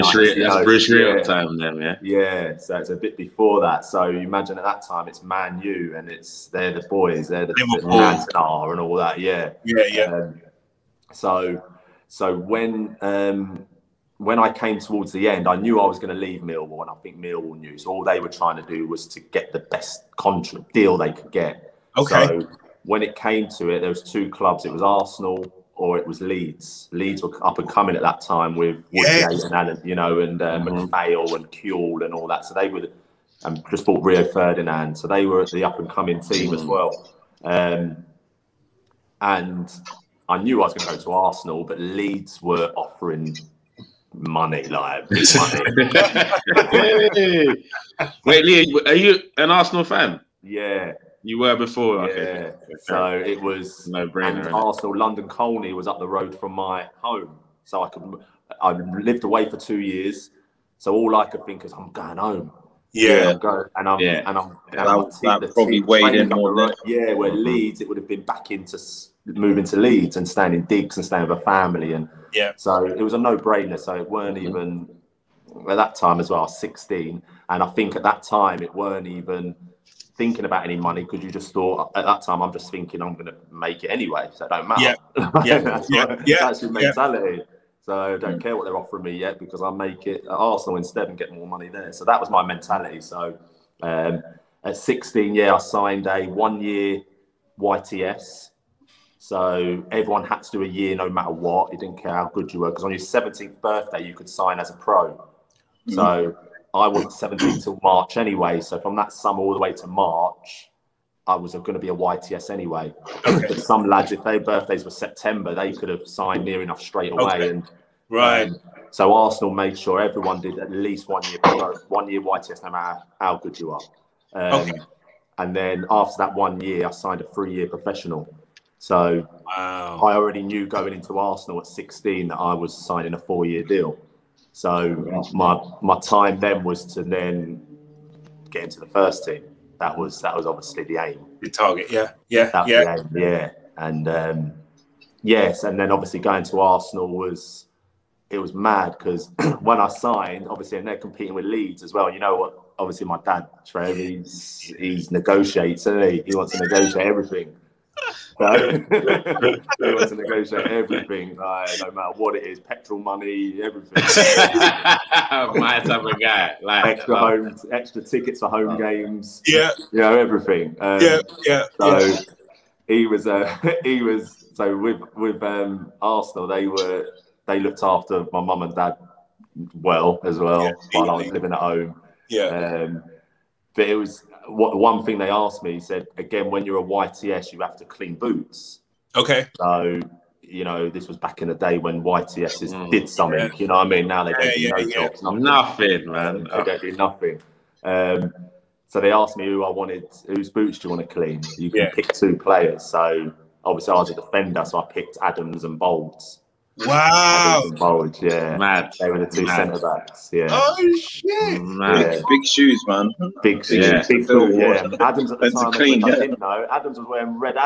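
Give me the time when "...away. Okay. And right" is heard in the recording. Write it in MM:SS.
01:57.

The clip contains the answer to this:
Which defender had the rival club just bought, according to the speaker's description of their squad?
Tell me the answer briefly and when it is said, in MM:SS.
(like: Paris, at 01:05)
Rio Ferdinand, at 00:34.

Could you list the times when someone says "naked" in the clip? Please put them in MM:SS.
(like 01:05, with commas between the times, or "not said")
not said.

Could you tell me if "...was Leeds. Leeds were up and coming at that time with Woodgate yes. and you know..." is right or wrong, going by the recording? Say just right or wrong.
right.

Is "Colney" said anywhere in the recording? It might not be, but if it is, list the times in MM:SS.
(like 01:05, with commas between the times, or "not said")
00:55.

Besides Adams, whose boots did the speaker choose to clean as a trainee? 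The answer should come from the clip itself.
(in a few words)
Bould.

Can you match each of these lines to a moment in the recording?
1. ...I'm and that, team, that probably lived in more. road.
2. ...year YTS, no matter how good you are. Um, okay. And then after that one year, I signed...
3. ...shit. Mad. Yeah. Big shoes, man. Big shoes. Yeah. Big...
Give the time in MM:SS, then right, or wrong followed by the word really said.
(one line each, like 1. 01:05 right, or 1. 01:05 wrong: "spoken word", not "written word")
1. 01:04 wrong: "weighed", not "lived"
2. 02:02 right
3. 03:31 right.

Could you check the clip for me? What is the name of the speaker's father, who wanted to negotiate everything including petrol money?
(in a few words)
Trev.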